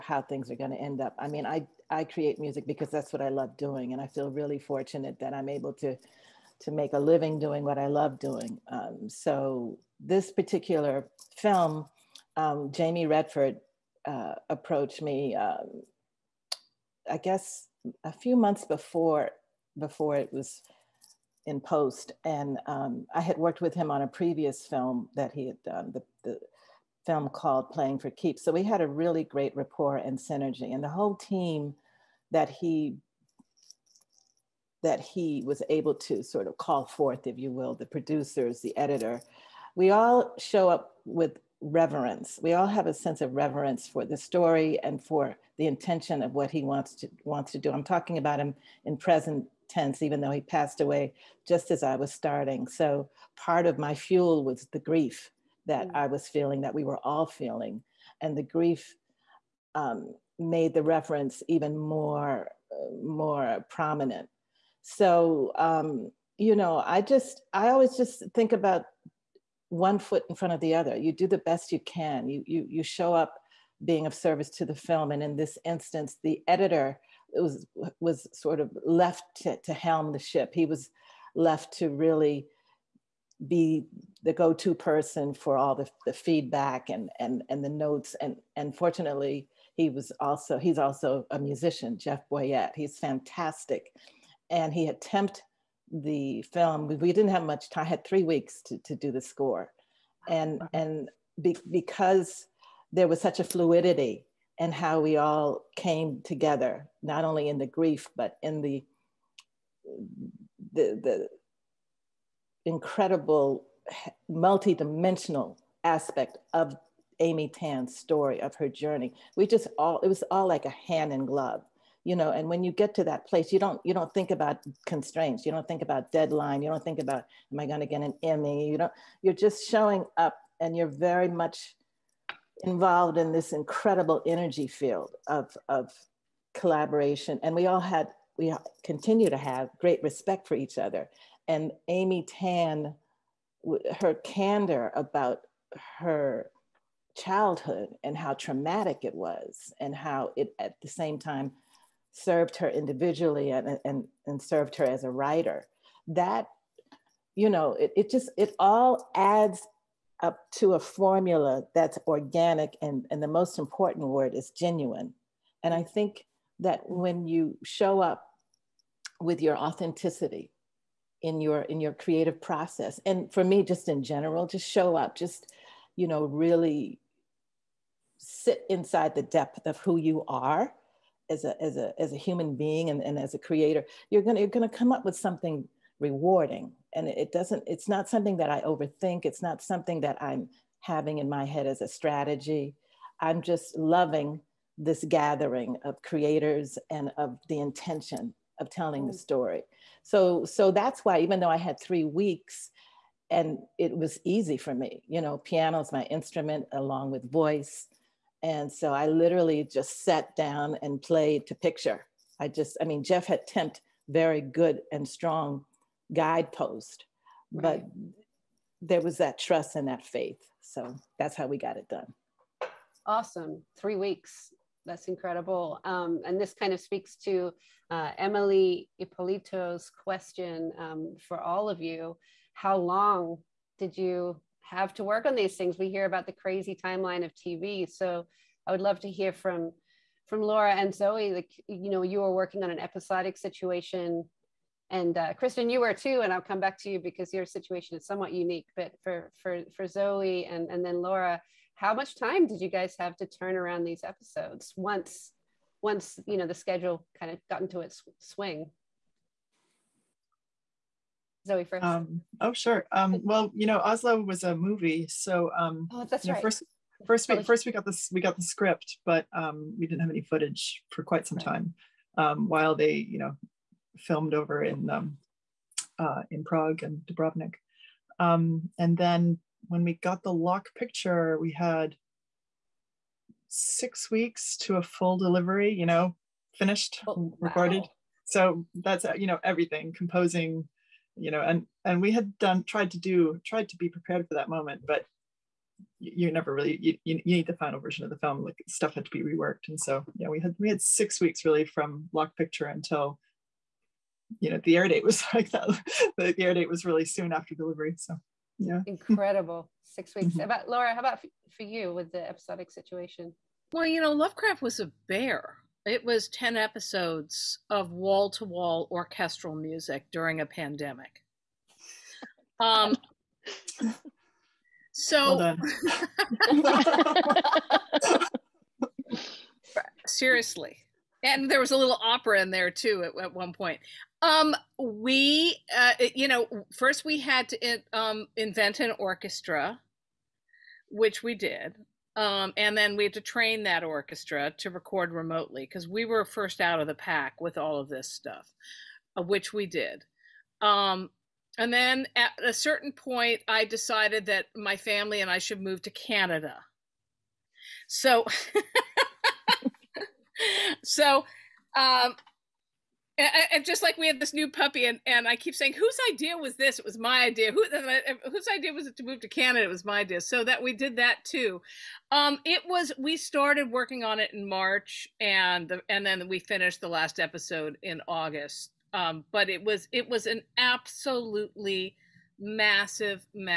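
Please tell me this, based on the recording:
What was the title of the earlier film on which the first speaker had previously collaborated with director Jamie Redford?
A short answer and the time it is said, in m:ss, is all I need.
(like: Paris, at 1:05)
Playing for Keeps, at 0:27.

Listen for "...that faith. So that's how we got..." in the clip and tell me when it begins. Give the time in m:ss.
3:39.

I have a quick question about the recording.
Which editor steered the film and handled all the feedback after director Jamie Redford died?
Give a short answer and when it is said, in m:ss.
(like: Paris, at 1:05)
Jeff Boyette, at 1:31.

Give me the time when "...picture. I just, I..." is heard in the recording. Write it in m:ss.
3:31.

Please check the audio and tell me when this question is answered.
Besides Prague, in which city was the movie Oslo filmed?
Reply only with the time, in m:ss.
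4:37.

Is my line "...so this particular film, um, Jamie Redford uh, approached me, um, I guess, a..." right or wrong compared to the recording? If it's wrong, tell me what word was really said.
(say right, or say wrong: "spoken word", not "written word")
right.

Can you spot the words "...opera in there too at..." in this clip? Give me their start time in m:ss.
5:32.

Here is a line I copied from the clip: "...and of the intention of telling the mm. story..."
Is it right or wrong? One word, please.
right.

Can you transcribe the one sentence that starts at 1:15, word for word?
And in this instance, the editor was, was sort of left to, to helm the ship.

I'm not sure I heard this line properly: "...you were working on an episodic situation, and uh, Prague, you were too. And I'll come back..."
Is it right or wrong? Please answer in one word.
wrong.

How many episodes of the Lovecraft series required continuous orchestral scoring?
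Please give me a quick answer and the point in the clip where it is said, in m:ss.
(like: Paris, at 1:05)
10, at 5:16.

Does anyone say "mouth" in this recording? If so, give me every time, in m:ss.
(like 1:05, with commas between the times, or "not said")
not said.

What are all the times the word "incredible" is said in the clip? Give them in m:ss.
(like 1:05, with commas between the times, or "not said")
1:52, 2:13, 3:45, 5:08.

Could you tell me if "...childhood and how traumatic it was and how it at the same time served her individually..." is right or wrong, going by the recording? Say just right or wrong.
right.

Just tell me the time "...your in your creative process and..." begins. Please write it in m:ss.
2:51.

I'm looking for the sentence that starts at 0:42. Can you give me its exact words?
We all have a sense of reverence for the story and for the intention of what he wants to wants to do.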